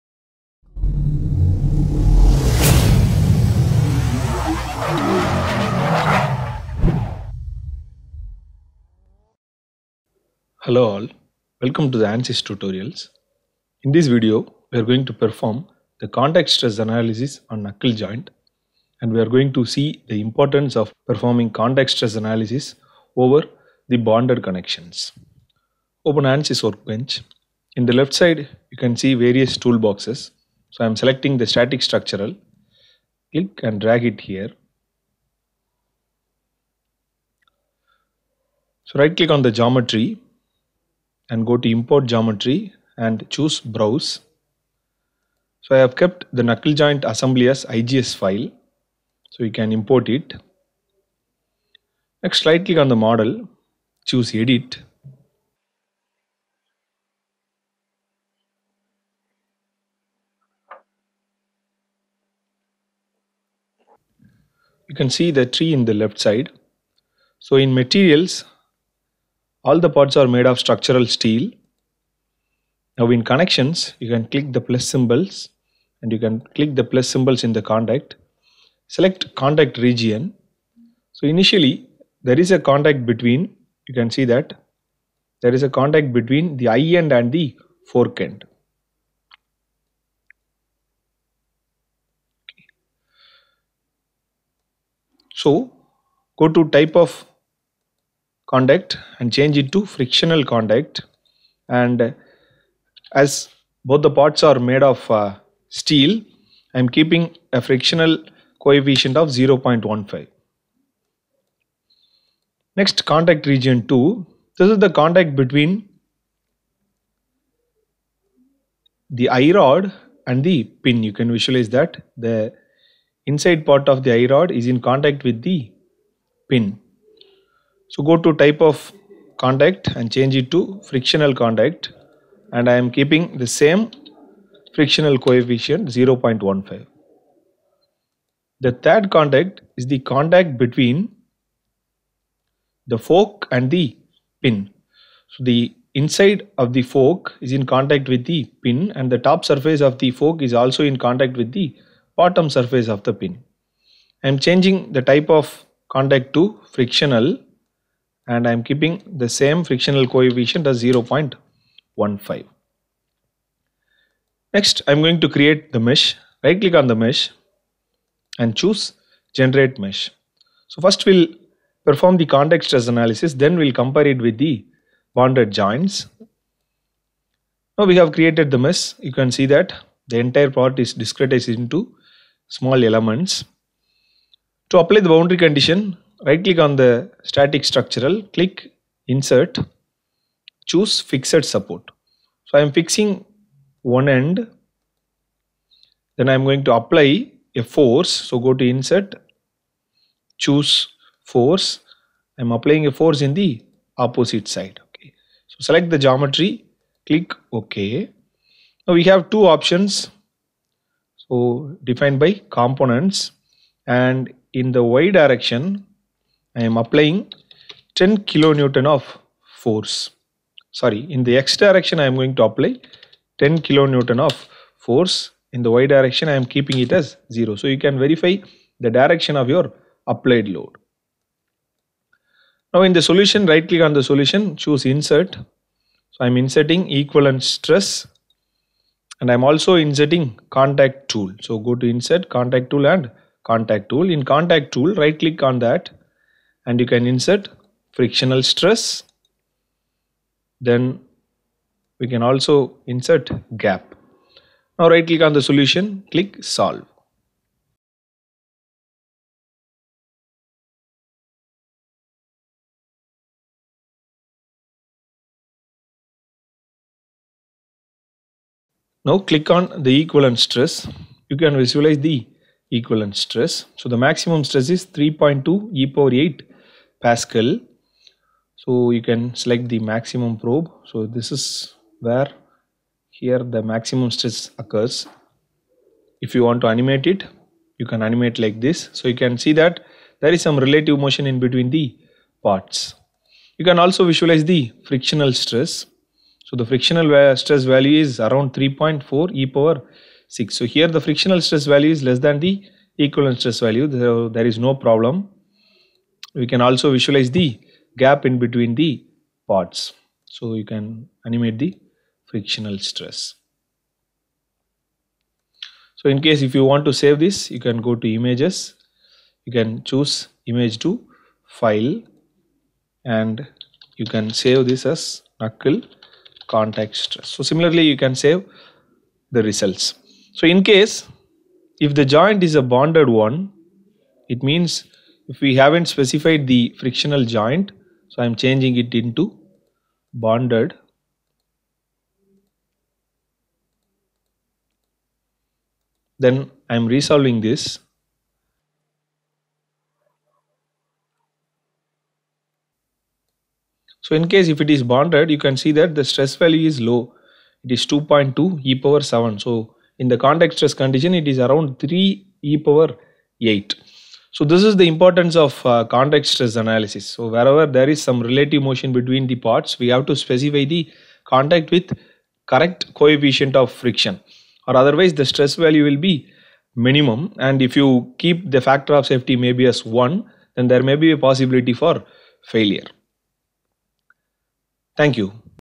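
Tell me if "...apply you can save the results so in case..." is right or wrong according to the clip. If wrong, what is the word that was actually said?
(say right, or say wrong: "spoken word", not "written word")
wrong: "similarly", not "apply".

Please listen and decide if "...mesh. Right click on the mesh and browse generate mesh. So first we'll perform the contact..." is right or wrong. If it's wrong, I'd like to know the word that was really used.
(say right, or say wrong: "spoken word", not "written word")
wrong: "choose", not "browse".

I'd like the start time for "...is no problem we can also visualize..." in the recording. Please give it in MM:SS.
05:04.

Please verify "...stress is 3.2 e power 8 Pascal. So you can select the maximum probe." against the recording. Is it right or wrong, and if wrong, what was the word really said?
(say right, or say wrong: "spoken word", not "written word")
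right.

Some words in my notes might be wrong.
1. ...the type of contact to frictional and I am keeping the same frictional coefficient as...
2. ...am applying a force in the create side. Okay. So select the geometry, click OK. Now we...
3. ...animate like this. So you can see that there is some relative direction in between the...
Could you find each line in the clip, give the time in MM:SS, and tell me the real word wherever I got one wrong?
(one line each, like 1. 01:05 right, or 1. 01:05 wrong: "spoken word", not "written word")
1. 02:34 right
2. 03:22 wrong: "opposite", not "create"
3. 04:48 wrong: "motion", not "direction".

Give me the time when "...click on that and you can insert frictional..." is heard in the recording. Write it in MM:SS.
04:05.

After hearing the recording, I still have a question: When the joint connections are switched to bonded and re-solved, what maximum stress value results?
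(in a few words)
2.2e7 Pa.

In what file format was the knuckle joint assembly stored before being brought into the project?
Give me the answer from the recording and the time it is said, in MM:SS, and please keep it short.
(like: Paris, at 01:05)
IGS, at 00:47.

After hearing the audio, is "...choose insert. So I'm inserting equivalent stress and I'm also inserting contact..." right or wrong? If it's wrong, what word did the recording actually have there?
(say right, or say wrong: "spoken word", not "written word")
right.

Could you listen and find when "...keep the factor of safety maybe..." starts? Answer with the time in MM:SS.
06:18.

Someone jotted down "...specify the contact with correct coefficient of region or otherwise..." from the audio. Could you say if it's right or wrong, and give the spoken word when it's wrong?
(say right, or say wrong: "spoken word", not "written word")
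wrong: "friction", not "region".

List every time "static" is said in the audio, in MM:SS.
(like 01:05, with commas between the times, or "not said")
00:31, 03:07.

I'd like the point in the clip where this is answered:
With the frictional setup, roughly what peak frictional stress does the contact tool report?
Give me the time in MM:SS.
04:58.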